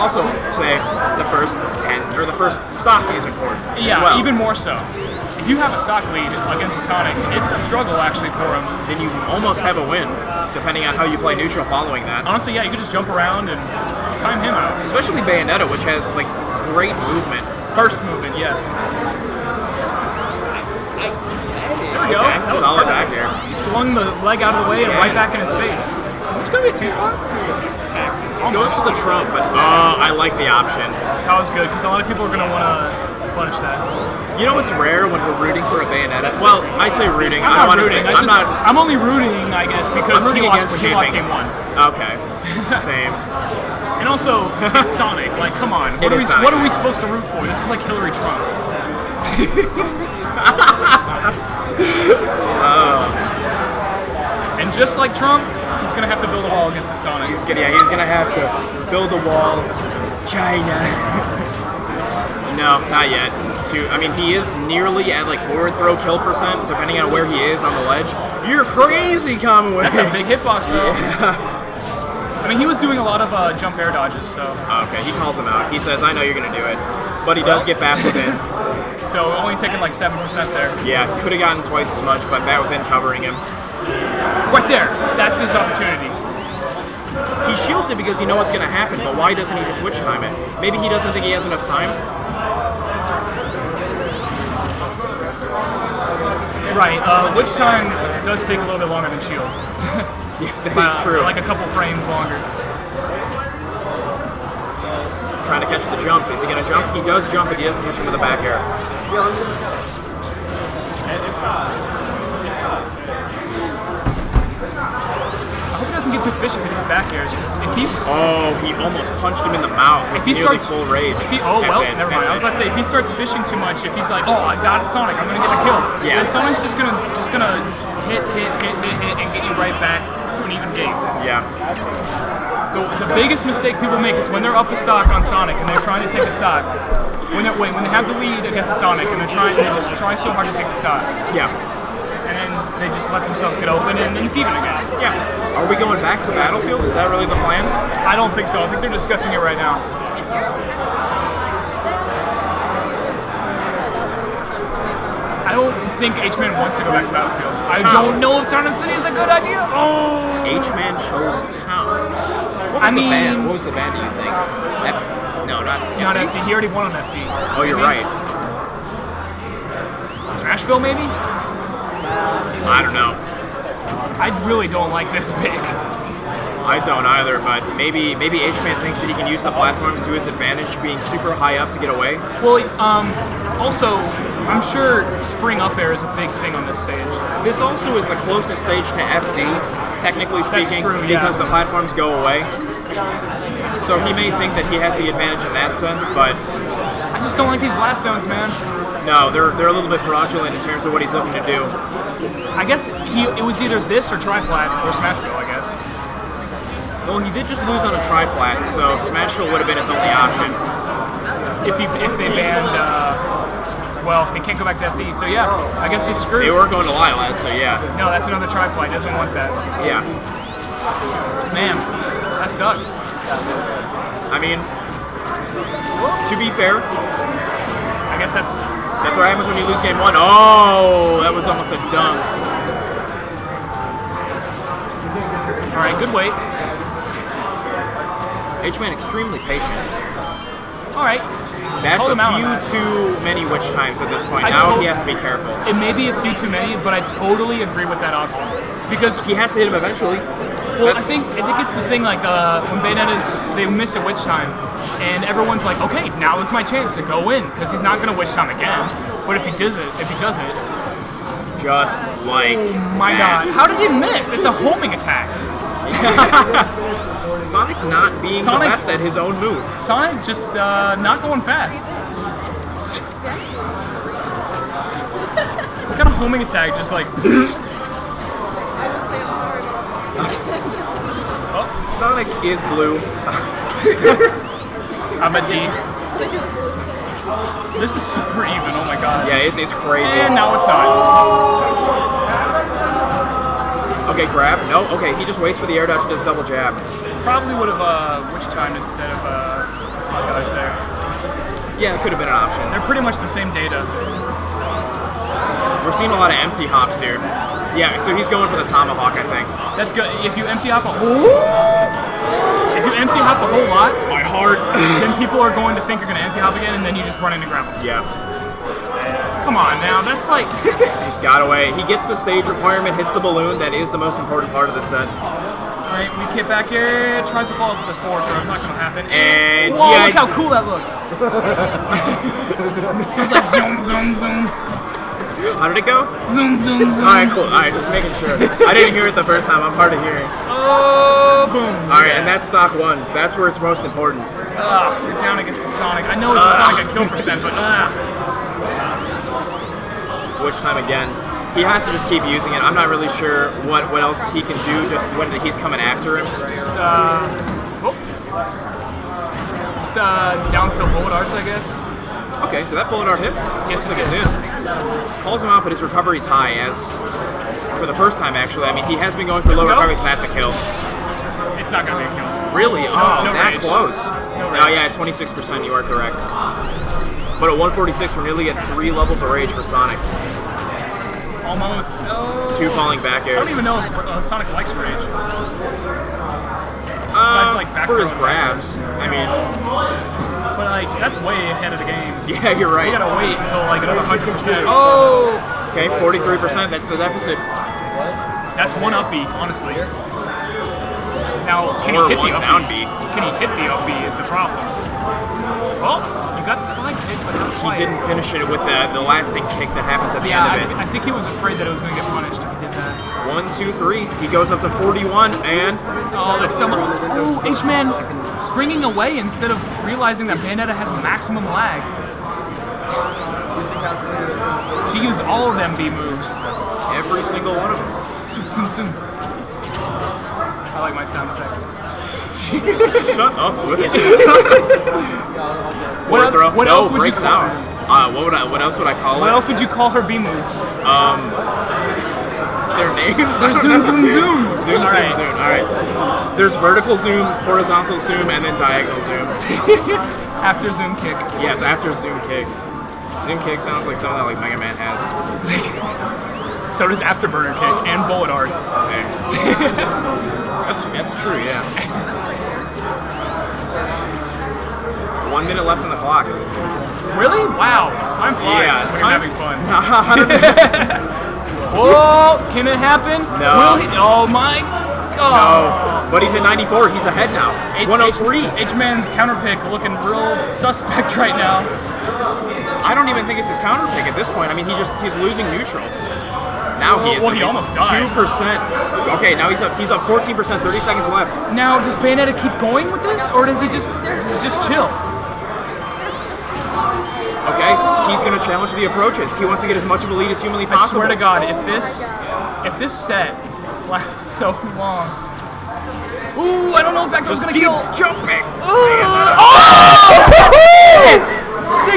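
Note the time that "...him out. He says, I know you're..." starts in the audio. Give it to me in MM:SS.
01:15.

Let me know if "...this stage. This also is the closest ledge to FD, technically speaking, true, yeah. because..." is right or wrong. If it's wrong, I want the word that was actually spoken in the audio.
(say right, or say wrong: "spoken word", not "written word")
wrong: "stage", not "ledge".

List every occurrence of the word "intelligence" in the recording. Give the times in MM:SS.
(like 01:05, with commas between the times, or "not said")
not said.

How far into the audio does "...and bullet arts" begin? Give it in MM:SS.
07:37.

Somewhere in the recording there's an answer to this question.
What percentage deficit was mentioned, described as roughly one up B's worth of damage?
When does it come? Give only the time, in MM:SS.
06:35.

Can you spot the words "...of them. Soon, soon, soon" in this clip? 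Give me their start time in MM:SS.
07:07.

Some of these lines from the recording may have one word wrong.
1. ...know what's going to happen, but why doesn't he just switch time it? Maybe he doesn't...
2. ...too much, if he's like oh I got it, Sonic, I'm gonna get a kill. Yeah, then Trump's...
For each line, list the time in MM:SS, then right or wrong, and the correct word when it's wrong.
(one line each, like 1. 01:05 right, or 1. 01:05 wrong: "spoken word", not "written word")
1. 01:28 right
2. 02:03 wrong: "Sonic", not "Trump".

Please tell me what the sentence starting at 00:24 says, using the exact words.
and right back in his face.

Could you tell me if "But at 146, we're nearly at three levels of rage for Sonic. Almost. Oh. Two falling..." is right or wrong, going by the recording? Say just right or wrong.
right.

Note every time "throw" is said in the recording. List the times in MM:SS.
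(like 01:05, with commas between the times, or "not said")
01:05, 05:28.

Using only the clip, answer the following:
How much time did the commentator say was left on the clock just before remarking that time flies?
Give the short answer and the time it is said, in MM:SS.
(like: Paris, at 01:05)
1 minute, at 07:45.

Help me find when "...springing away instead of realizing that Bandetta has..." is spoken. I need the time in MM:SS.
06:58.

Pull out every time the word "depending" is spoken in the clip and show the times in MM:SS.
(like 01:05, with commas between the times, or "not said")
00:10, 01:06.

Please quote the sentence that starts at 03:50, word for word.
Oh, that was almost a dunk.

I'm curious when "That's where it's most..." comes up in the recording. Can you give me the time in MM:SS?
05:43.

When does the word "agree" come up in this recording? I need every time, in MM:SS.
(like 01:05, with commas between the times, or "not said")
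04:07.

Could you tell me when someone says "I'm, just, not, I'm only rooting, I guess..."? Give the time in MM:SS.
00:38.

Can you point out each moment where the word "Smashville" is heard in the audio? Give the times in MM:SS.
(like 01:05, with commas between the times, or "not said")
02:50, 03:24, 03:29.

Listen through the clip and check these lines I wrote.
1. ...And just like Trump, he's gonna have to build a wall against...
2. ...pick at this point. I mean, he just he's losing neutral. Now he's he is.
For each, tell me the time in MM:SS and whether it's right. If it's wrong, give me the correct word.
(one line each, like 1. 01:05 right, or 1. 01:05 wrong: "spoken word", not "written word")
1. 00:54 right
2. 08:03 right.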